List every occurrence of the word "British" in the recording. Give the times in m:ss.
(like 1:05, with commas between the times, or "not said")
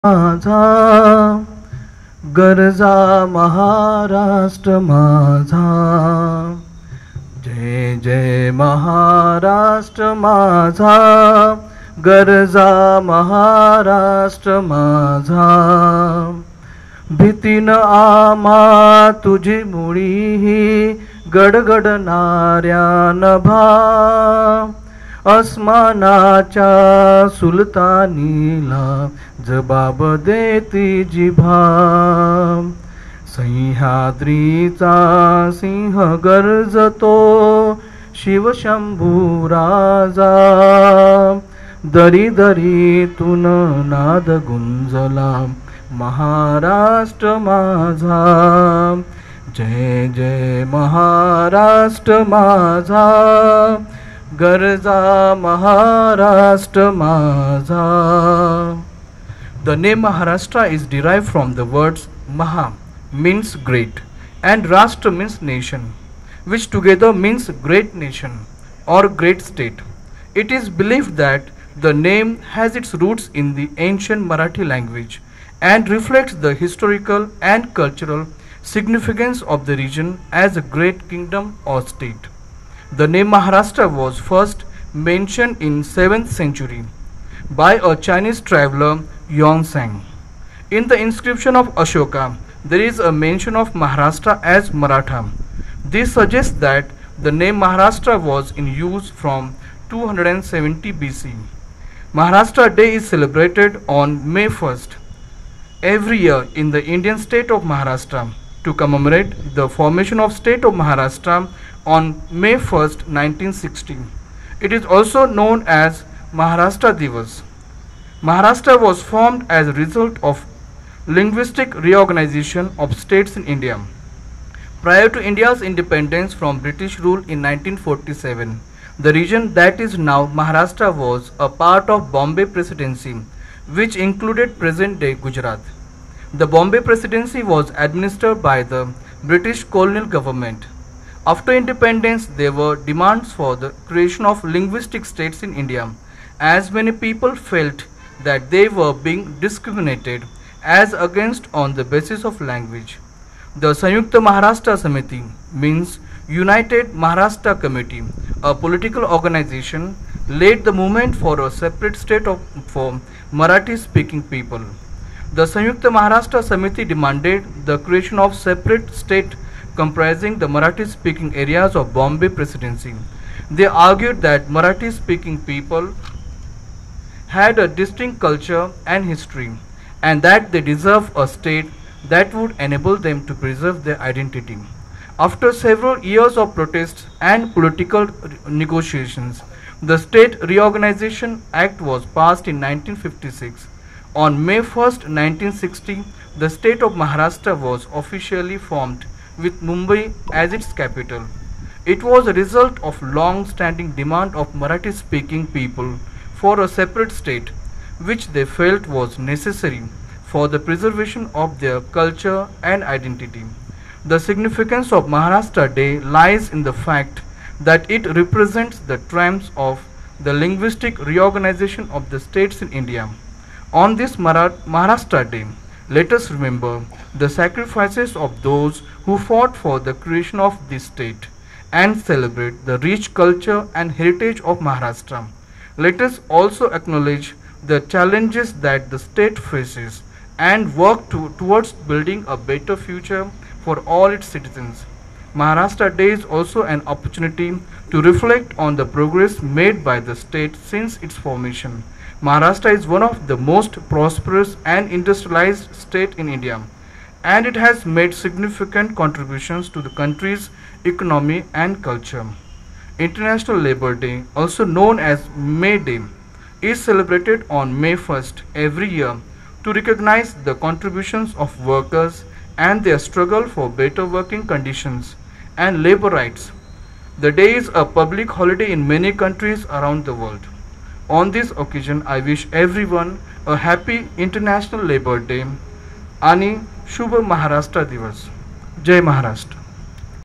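2:06, 2:19.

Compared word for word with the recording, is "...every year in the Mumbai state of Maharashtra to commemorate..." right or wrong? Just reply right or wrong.
wrong.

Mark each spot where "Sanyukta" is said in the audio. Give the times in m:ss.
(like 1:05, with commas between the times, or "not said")
2:33, 2:45.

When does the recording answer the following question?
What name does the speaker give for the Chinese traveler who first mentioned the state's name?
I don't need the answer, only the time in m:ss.
1:29.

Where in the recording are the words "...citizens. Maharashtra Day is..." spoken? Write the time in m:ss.
4:04.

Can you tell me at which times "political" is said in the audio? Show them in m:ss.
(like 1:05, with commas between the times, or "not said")
2:38, 3:07.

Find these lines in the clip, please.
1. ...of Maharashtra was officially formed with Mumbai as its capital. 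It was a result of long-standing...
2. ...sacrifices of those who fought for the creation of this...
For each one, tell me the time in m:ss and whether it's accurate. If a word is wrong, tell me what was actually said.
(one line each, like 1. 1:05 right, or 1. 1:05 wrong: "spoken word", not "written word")
1. 3:16 right
2. 3:47 right.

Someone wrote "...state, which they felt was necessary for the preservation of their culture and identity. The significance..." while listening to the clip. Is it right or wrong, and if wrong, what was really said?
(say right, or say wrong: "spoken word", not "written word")
right.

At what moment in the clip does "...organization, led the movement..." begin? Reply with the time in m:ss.
2:39.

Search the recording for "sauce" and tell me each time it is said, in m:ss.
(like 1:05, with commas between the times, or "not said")
not said.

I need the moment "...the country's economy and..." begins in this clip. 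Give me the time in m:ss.
4:19.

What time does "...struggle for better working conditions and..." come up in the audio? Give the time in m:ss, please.
4:32.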